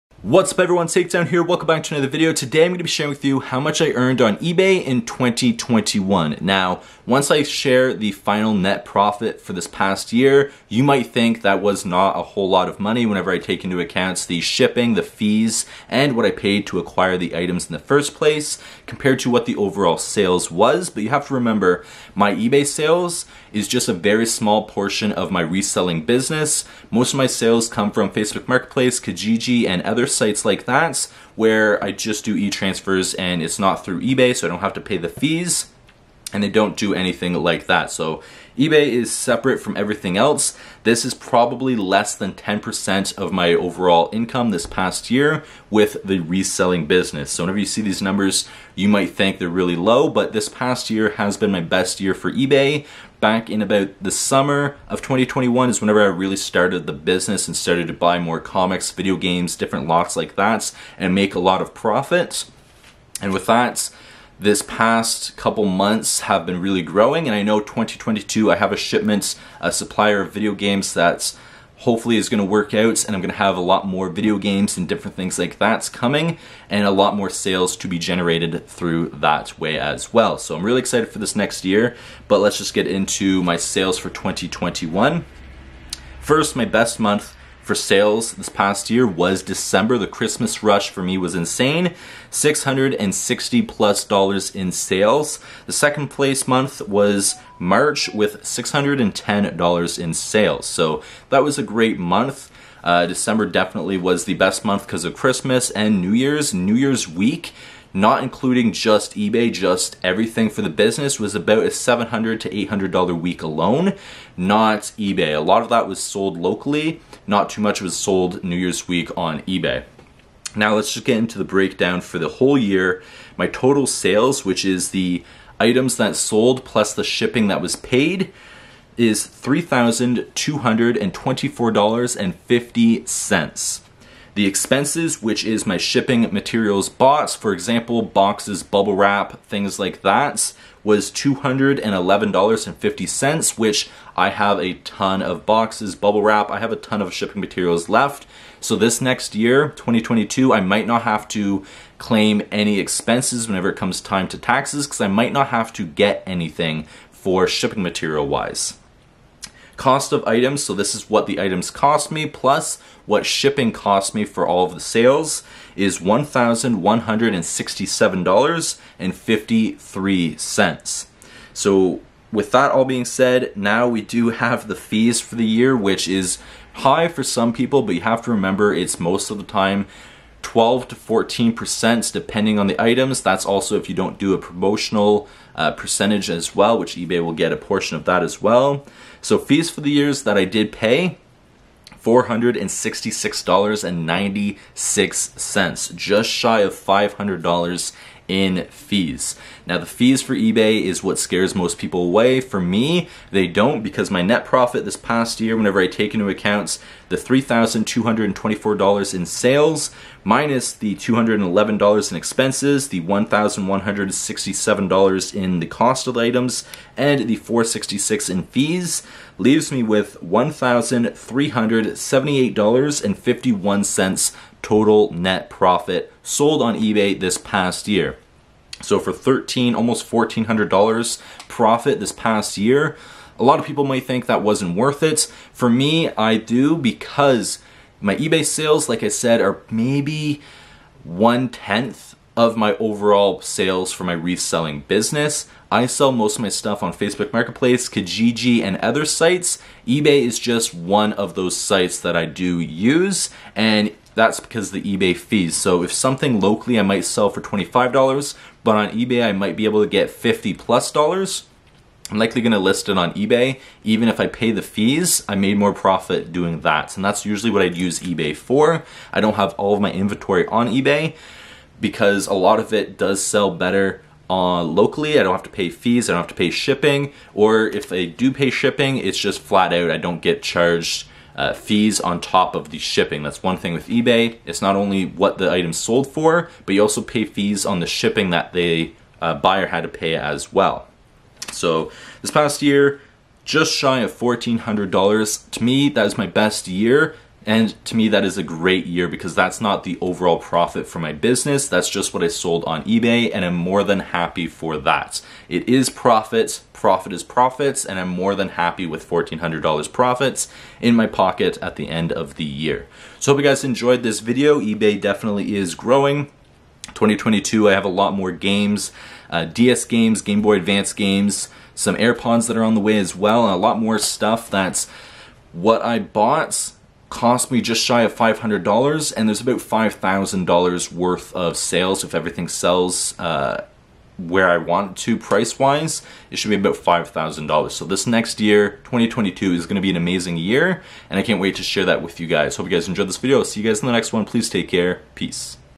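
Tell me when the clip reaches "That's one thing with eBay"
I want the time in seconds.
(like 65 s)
283 s.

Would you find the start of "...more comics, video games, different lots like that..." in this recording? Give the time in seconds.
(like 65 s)
58 s.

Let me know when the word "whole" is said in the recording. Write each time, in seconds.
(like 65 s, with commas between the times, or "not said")
12 s, 122 s.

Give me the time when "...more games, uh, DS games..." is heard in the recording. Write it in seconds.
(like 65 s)
318 s.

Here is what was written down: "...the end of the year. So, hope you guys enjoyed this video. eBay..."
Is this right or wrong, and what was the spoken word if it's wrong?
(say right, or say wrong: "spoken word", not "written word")
right.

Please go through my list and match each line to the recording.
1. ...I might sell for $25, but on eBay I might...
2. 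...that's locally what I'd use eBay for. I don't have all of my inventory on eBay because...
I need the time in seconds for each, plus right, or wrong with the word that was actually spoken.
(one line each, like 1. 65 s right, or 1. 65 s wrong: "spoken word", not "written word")
1. 256 s right
2. 267 s wrong: "usually", not "locally".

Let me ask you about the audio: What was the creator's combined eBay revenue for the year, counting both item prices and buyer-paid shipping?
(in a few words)
$3,224.50.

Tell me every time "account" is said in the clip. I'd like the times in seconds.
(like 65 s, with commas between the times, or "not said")
13 s, 206 s.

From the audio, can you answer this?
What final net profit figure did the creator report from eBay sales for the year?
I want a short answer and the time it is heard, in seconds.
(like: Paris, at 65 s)
$1,378.51, at 220 s.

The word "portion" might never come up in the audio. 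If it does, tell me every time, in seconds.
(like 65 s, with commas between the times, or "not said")
24 s, 187 s.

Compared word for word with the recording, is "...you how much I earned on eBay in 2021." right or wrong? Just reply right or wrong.
right.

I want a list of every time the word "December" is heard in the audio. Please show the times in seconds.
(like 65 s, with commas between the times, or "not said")
89 s, 103 s.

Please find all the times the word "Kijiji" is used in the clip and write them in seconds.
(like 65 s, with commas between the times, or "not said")
28 s, 247 s.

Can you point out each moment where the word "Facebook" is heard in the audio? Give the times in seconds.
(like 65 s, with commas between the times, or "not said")
28 s, 246 s.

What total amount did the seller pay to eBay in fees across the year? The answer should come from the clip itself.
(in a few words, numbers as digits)
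$466.96.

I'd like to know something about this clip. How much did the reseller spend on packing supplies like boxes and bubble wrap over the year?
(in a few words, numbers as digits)
$211.50.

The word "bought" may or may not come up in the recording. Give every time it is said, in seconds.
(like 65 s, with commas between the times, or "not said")
136 s, 325 s.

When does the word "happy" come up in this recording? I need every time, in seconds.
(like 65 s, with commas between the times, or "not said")
303 s, 308 s.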